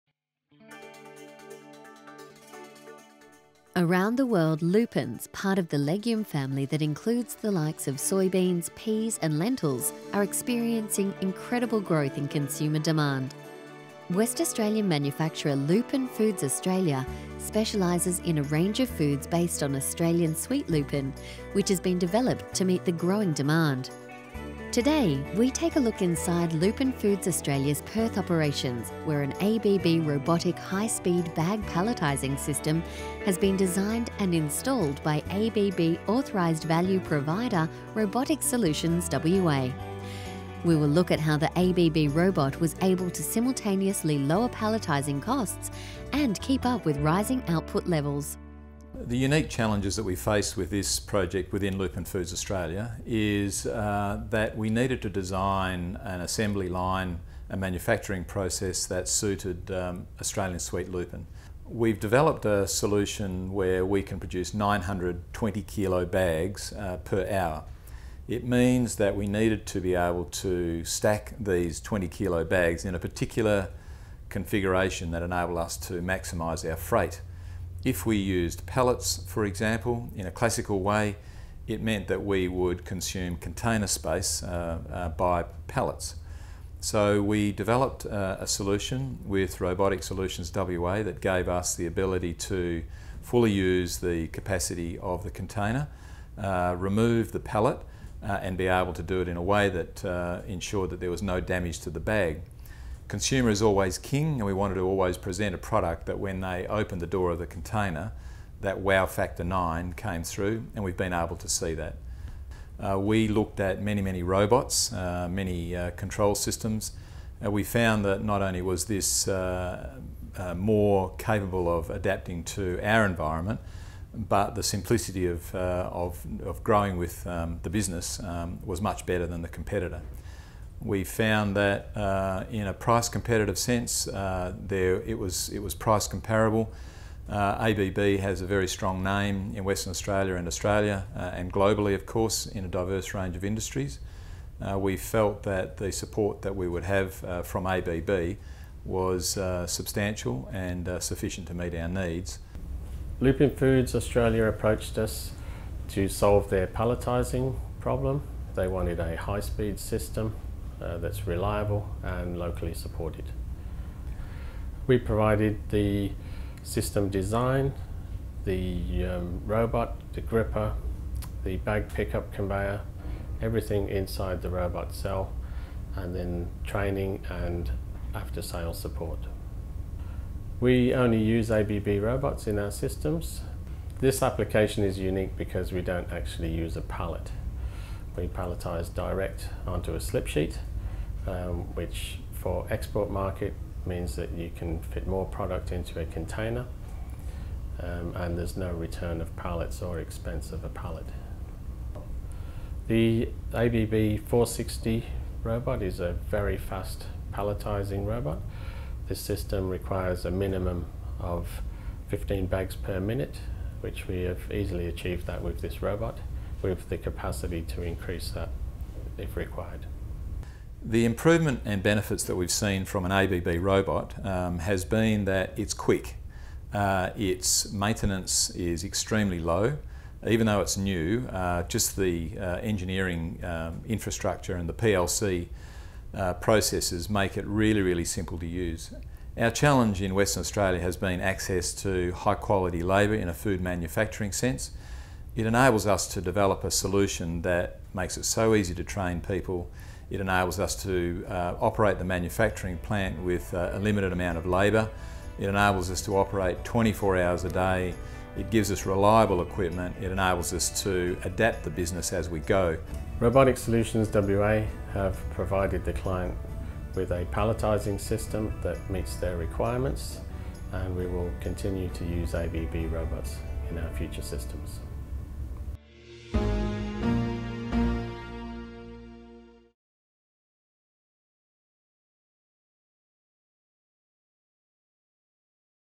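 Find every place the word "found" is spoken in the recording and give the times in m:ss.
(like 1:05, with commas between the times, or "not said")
1:57, 2:11.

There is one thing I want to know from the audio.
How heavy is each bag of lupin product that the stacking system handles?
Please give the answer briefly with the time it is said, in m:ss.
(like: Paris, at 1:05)
20 kilos, at 1:11.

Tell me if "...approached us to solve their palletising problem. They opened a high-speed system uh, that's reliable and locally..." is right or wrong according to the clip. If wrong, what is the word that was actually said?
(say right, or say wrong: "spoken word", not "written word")
wrong: "wanted", not "opened".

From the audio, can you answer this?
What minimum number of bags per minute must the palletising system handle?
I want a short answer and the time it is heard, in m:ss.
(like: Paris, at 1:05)
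15, at 3:32.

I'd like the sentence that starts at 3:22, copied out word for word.
The ABB 460 robot is a very fast palletizing robot.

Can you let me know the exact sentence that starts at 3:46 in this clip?
Uh, its maintenance is extremely low.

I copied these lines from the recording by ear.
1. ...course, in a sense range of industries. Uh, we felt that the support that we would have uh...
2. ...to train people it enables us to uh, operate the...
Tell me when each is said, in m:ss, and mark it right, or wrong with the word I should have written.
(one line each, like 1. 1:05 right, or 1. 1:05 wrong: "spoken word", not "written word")
1. 2:22 wrong: "diverse", not "sense"
2. 4:08 right.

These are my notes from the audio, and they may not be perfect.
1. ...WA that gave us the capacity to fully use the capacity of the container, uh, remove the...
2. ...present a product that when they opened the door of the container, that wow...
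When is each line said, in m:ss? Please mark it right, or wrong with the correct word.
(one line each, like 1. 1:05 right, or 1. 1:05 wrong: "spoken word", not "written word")
1. 1:30 wrong: "ability", not "capacity"
2. 1:45 right.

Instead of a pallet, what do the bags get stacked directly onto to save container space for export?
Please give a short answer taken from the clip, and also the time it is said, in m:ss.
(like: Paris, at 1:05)
a slip sheet, at 3:10.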